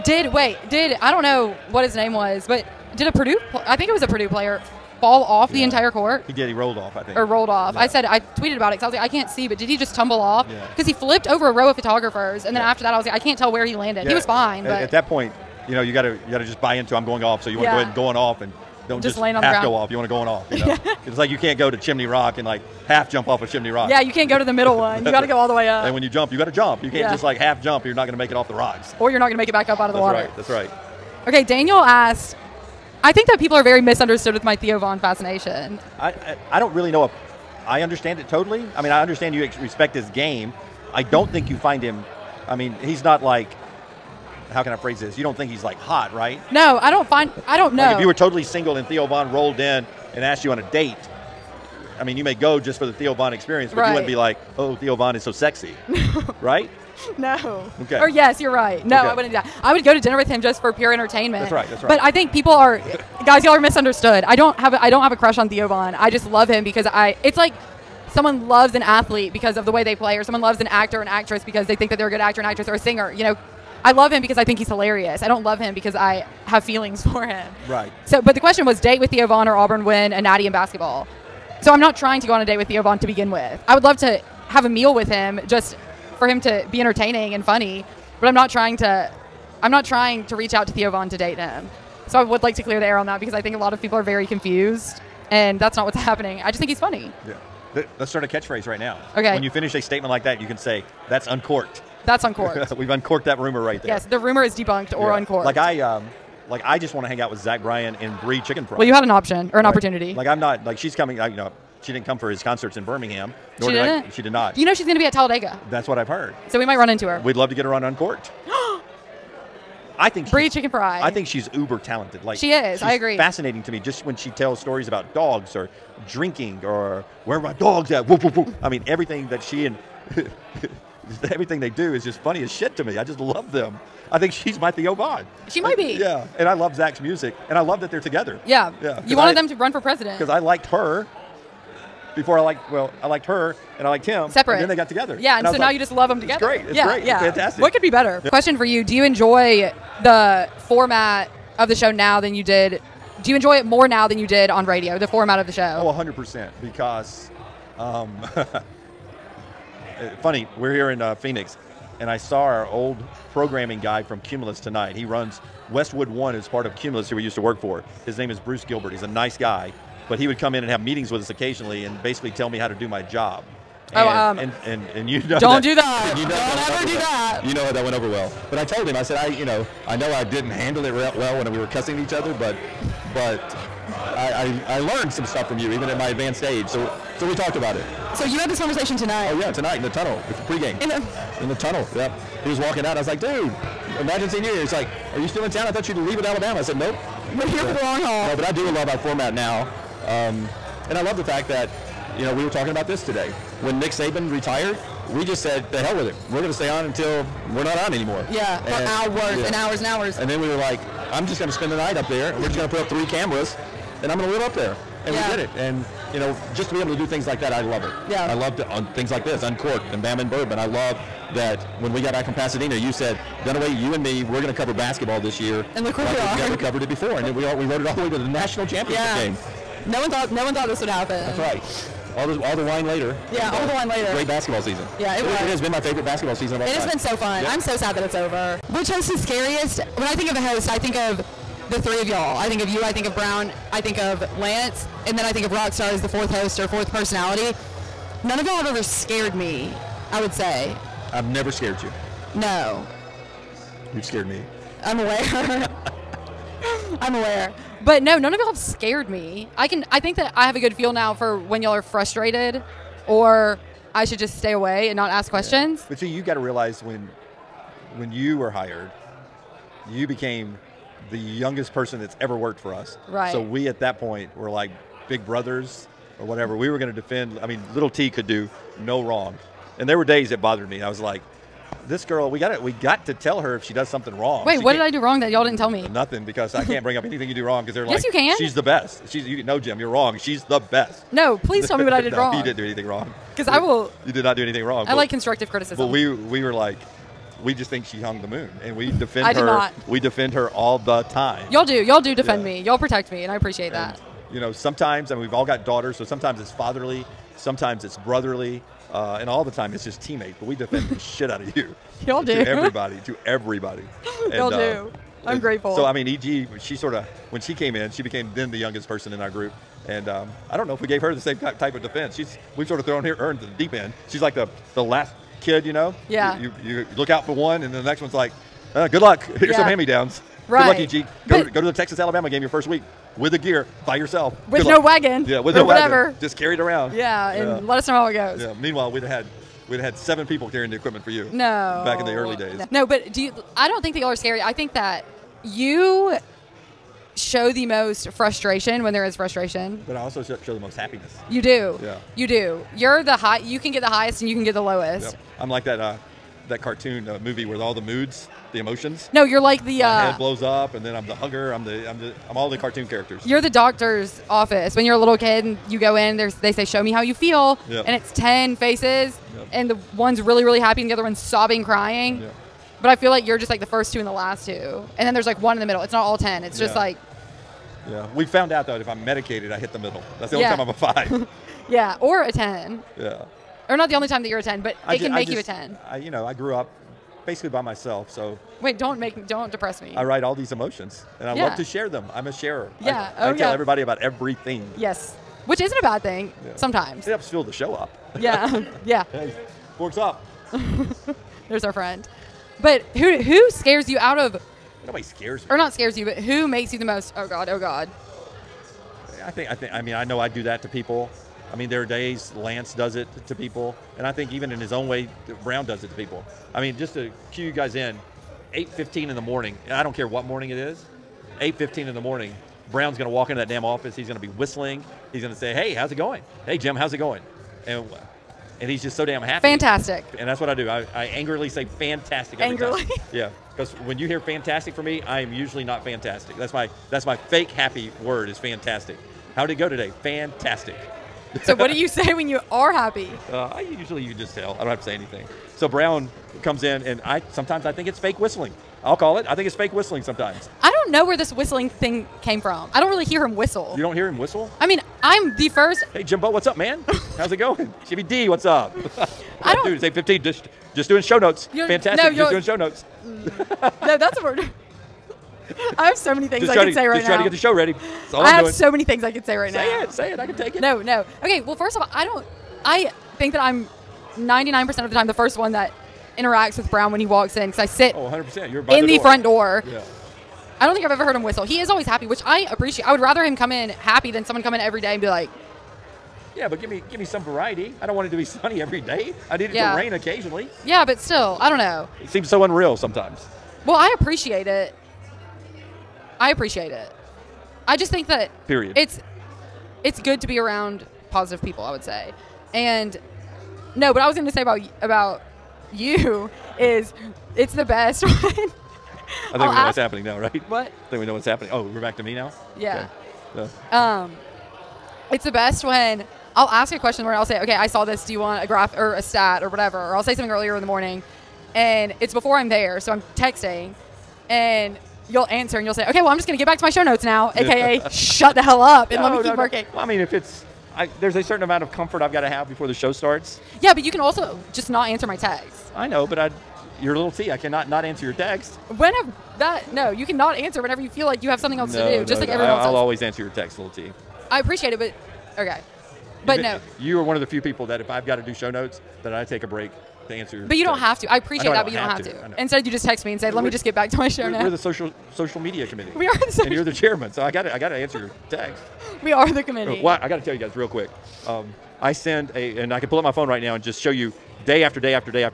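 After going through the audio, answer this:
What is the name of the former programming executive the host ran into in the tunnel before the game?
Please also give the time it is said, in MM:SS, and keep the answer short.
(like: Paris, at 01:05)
Bruce Gilbert, at 02:48.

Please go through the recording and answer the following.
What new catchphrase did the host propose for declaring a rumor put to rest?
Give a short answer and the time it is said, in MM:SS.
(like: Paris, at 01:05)
That's uncorked, at 01:41.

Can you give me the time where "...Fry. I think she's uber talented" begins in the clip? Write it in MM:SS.
02:00.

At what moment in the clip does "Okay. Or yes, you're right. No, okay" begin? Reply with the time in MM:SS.
00:57.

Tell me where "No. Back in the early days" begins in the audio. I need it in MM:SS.
05:41.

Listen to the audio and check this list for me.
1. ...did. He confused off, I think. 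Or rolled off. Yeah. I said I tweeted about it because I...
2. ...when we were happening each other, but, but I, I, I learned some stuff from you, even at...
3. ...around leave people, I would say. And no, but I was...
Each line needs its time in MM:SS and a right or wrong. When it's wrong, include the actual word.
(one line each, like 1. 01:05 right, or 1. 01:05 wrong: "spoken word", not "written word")
1. 00:06 wrong: "rolled", not "confused"
2. 03:01 wrong: "cussing", not "happening"
3. 08:20 wrong: "positive", not "leave".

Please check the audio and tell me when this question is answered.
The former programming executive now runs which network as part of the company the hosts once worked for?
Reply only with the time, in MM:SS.
02:45.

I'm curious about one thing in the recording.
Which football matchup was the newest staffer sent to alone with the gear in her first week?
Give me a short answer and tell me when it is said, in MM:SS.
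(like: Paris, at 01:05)
Texas Alabama, at 05:31.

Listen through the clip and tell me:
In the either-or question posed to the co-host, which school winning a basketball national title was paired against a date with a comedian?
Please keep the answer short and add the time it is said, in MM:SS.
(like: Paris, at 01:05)
Auburn, at 01:19.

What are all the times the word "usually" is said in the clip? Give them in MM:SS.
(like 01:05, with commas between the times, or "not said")
07:15, 07:23.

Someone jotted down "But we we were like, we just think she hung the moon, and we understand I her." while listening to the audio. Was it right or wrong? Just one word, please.
wrong.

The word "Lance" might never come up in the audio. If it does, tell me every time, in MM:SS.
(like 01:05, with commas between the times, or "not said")
04:04, 06:52.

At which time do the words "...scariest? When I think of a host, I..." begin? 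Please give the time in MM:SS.
03:59.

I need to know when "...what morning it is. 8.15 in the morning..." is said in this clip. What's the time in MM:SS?
07:00.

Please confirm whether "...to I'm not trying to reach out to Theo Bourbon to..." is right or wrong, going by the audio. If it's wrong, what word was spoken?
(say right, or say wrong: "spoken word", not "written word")
wrong: "Von", not "Bourbon".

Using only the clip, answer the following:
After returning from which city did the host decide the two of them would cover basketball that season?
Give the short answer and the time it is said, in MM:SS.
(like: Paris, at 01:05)
Pasadena, at 03:42.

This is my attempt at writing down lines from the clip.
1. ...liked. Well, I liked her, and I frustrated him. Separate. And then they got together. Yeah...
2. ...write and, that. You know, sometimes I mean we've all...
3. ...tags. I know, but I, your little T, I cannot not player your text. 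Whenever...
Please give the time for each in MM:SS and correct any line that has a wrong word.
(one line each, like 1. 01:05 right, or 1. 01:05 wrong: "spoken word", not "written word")
1. 02:22 wrong: "liked", not "frustrated"
2. 05:03 wrong: "appreciate", not "write"
3. 08:55 wrong: "answer", not "player".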